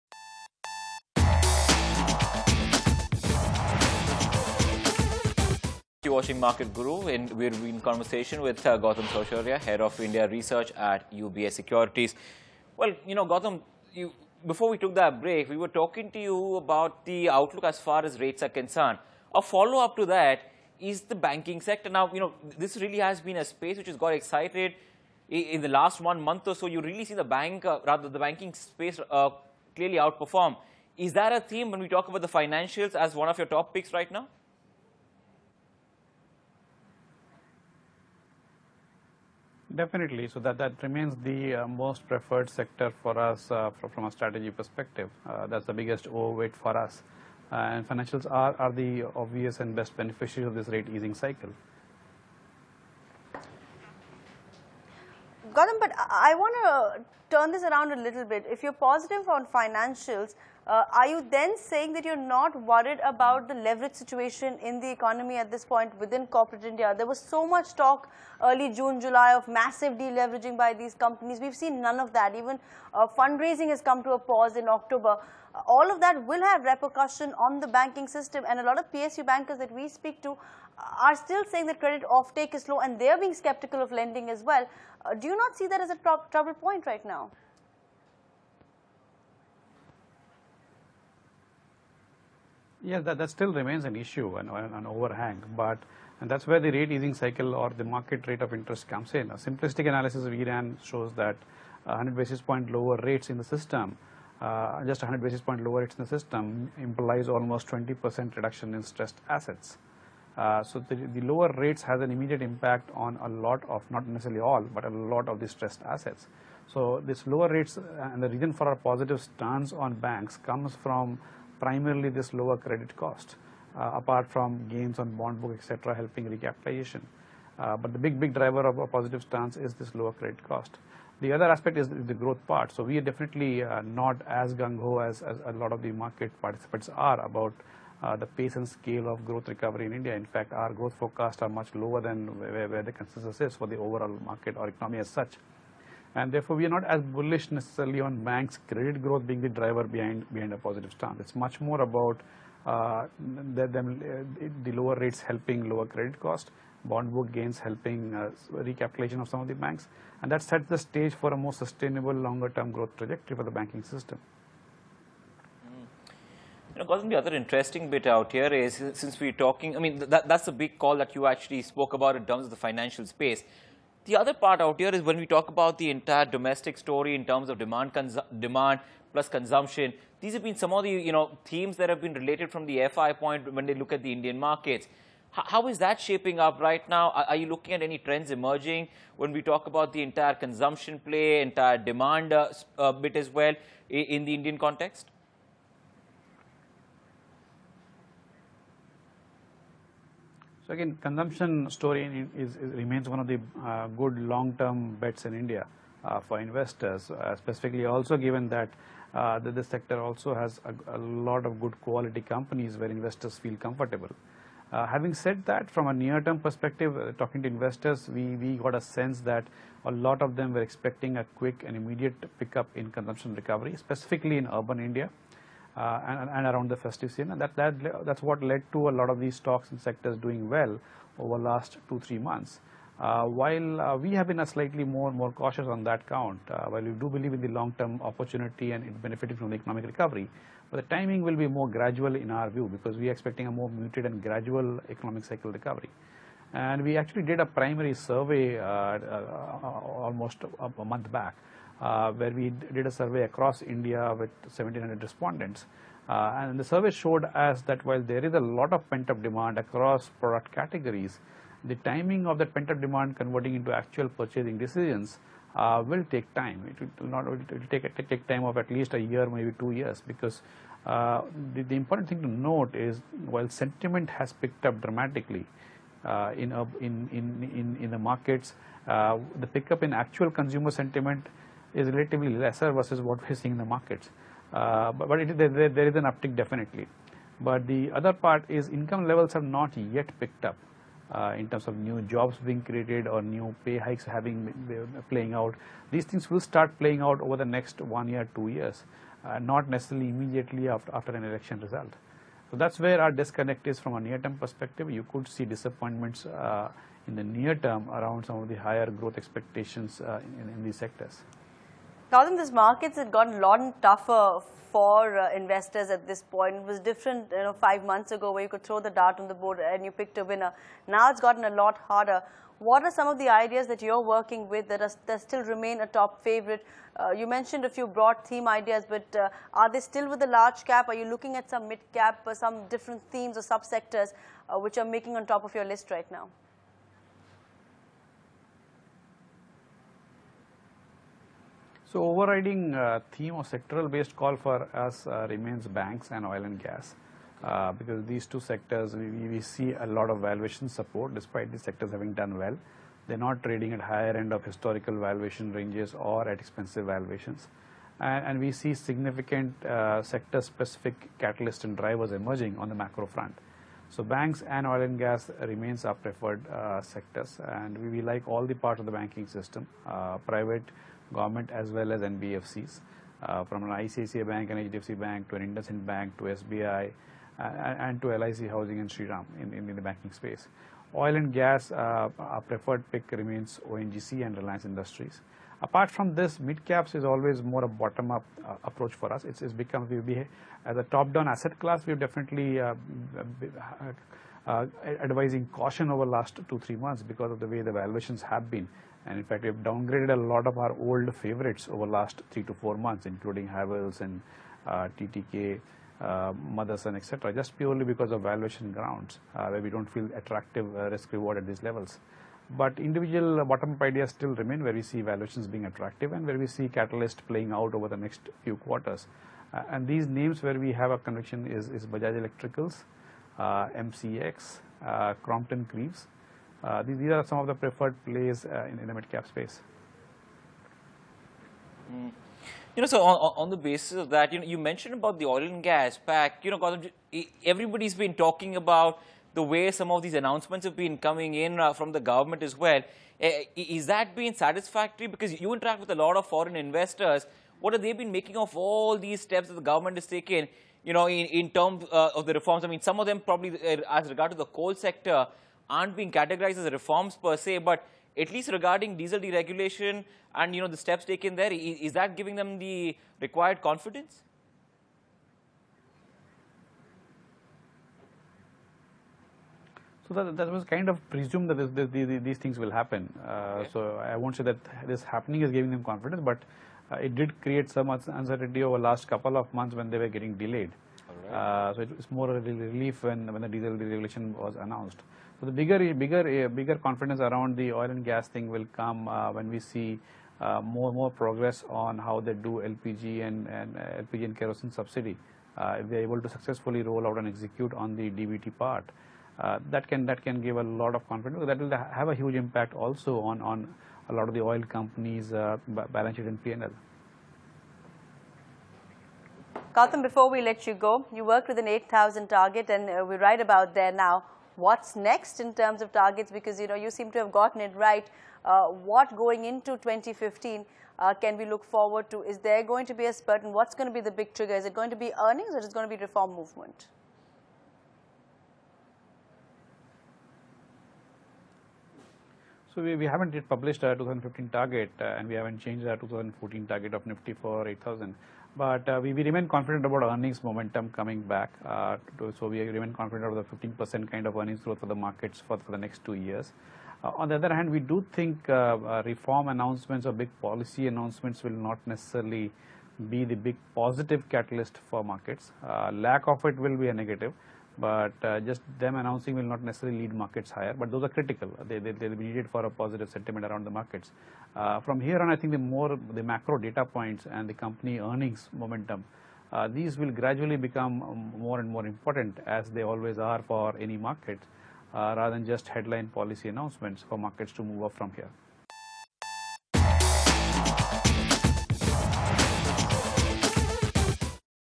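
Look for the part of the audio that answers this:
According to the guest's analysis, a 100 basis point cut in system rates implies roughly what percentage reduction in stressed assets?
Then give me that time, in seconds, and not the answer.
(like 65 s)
107 s.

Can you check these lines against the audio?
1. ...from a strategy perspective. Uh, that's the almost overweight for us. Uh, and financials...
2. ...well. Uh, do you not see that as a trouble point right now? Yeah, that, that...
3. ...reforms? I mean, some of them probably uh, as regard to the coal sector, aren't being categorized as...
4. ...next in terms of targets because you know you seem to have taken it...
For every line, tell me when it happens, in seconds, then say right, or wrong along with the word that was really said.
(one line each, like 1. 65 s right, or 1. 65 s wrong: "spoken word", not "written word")
1. 43 s wrong: "biggest", not "almost"
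2. 84 s right
3. 452 s right
4. 514 s wrong: "gotten", not "taken".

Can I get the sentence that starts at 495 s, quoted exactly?
if they're able to successfully roll out and execute on the DBT part, that can that can give a lot of confidence.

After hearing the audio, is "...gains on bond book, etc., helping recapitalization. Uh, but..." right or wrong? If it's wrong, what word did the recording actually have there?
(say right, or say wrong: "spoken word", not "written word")
right.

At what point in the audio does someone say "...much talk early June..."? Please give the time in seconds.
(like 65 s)
67 s.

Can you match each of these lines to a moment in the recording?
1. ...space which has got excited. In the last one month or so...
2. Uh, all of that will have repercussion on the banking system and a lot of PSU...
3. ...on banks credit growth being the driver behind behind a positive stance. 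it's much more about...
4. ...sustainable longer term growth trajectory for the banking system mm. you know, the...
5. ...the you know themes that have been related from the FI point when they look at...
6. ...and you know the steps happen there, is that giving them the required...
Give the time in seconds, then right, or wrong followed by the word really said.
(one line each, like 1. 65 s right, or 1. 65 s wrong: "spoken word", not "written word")
1. 23 s right
2. 75 s right
3. 148 s right
4. 161 s right
5. 180 s right
6. 460 s wrong: "taken", not "happen".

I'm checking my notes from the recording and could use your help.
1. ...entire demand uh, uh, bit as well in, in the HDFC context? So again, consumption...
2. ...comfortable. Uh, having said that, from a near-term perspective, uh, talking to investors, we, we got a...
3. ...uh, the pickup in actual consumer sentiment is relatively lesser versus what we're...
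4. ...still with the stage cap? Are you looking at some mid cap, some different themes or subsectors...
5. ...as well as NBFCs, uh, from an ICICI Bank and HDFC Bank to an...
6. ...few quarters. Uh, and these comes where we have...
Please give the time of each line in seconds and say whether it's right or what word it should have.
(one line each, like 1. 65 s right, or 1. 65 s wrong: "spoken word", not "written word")
1. 191 s wrong: "Indian", not "HDFC"
2. 213 s right
3. 278 s right
4. 329 s wrong: "large", not "stage"
5. 371 s right
6. 418 s wrong: "names", not "comes".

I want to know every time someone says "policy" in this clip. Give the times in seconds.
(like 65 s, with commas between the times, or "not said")
550 s, 576 s.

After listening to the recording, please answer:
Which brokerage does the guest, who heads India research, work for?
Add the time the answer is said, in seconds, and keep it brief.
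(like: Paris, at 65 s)
UBS Securities, at 11 s.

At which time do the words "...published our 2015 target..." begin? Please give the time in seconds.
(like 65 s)
533 s.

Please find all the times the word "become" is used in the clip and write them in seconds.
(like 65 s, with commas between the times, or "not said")
389 s, 570 s.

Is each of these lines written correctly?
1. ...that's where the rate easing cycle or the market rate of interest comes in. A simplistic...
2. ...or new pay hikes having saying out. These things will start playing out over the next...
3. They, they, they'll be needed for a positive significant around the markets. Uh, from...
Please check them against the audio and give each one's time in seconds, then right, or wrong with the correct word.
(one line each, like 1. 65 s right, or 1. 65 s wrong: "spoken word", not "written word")
1. 96 s right
2. 293 s wrong: "playing", not "saying"
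3. 561 s wrong: "sentiment", not "significant".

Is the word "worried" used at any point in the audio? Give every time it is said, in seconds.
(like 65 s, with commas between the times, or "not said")
62 s.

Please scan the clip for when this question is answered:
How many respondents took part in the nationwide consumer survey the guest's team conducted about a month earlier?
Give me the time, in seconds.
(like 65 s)
254 s.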